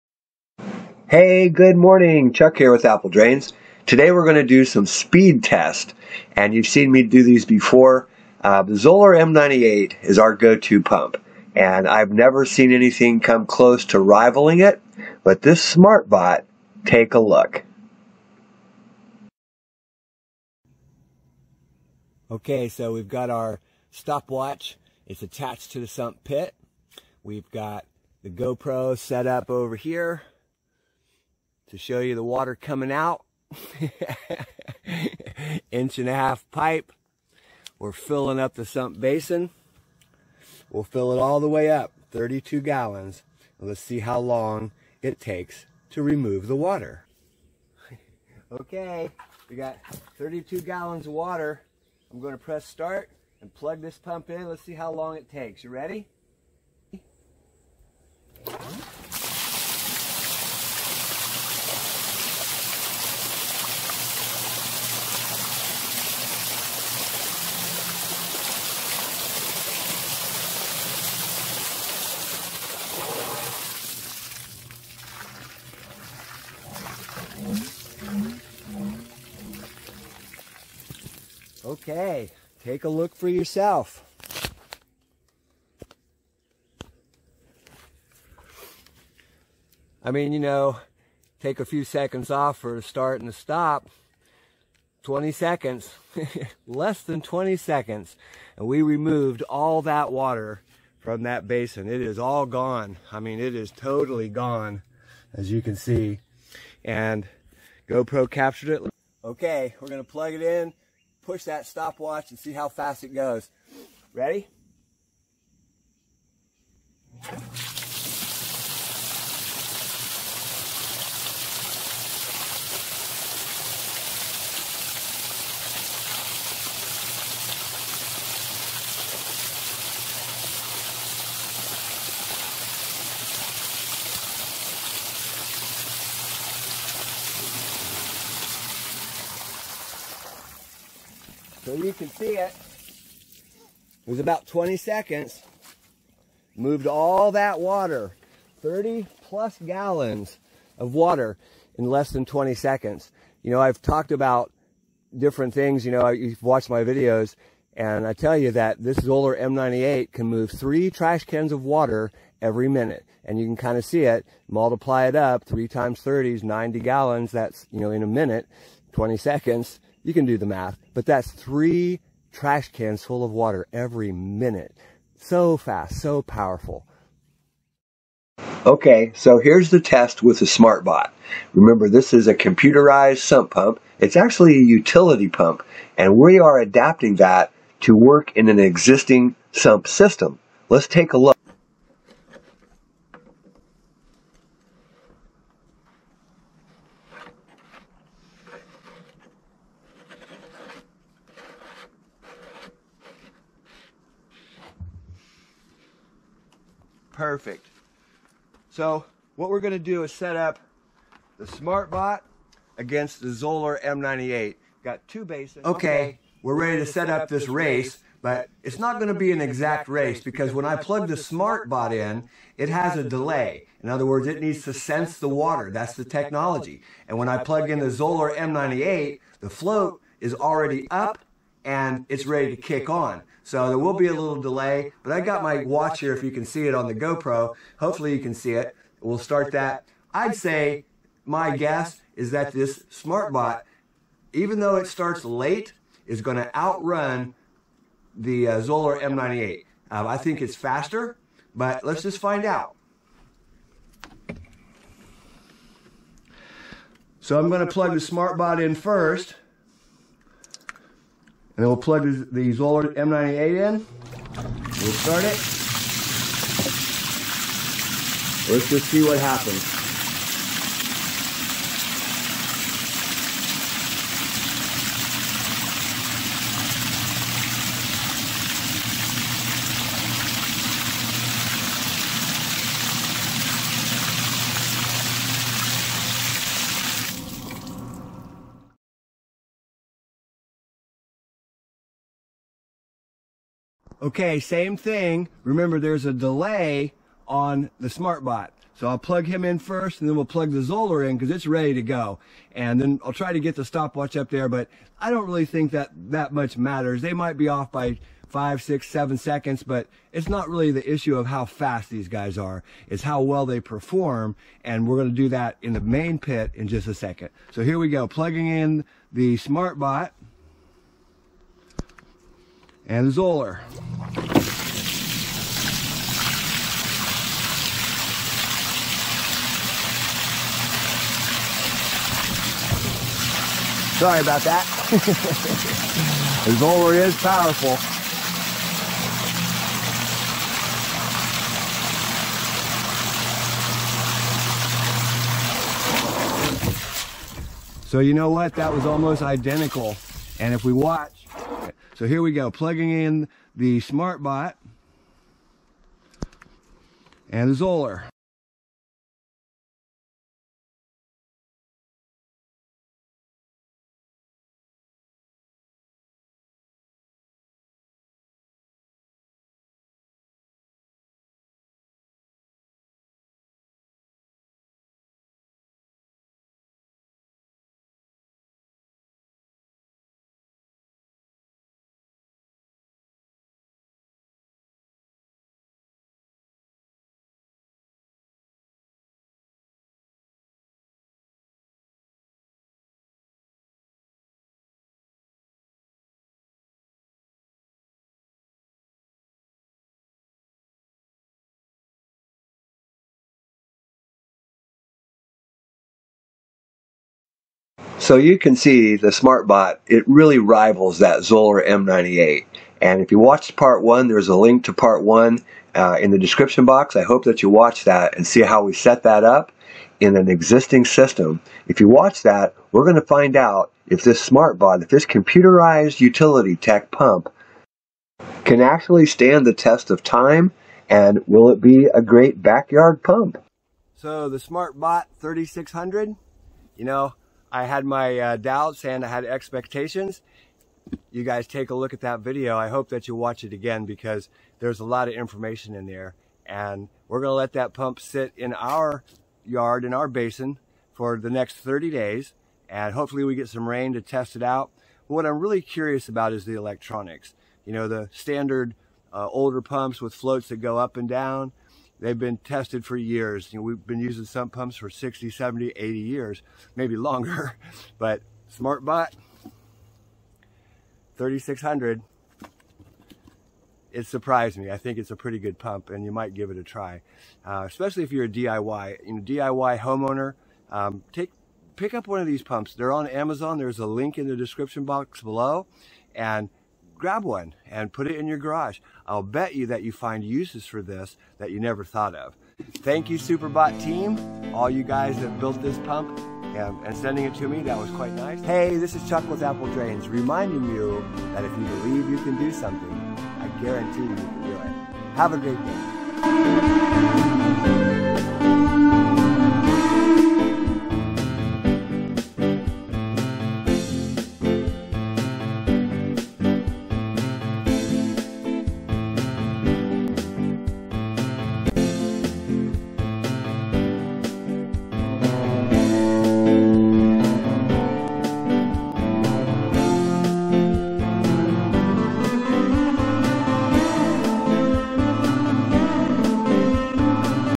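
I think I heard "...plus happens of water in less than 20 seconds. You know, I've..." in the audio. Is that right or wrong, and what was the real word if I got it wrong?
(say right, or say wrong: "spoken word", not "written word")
wrong: "gallons", not "happens".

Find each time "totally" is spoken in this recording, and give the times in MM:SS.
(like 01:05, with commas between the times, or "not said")
01:43.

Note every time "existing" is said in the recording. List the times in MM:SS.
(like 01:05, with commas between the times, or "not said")
03:08, 07:00.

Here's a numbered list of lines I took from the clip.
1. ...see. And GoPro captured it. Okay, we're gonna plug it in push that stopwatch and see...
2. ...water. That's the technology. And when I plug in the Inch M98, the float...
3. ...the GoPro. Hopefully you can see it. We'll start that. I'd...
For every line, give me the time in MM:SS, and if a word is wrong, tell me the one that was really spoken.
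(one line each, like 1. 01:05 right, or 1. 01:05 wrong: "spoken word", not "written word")
1. 01:45 right
2. 03:45 wrong: "Zoeller", not "Inch"
3. 03:56 right.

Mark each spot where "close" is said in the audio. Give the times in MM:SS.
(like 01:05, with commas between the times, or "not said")
00:13.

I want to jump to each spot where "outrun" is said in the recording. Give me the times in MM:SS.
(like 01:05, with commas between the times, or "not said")
04:06.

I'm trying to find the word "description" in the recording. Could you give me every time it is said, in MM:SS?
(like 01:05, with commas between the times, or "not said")
06:56, 08:04.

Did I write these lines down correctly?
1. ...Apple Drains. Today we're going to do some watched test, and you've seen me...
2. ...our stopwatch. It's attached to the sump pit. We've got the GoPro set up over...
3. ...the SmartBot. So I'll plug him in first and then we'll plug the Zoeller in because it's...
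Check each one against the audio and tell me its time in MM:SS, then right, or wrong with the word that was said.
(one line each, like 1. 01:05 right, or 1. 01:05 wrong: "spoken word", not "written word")
1. 00:02 wrong: "speed", not "watched"
2. 00:23 right
3. 04:57 right.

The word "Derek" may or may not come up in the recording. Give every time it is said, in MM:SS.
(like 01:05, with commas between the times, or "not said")
not said.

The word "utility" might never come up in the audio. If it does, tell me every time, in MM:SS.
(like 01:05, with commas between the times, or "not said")
03:04, 07:06.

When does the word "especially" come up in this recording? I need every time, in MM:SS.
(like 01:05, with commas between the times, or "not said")
07:57.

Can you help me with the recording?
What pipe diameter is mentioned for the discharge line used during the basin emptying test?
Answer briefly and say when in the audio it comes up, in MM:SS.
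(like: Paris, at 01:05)
Inch and a half, at 00:35.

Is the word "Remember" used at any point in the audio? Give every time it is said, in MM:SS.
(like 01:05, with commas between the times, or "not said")
03:01, 04:55.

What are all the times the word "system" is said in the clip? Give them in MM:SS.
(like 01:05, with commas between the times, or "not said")
03:09, 07:00.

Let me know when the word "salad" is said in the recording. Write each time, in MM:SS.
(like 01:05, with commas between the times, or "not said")
not said.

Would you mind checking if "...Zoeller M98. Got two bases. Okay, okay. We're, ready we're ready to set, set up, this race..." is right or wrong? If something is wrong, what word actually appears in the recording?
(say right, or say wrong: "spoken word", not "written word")
right.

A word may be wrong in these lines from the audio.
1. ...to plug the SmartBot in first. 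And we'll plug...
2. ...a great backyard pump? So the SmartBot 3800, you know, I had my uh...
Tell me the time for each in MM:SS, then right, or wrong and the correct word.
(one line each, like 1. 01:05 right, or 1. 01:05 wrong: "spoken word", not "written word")
1. 04:17 right
2. 07:11 wrong: "3600", not "3800".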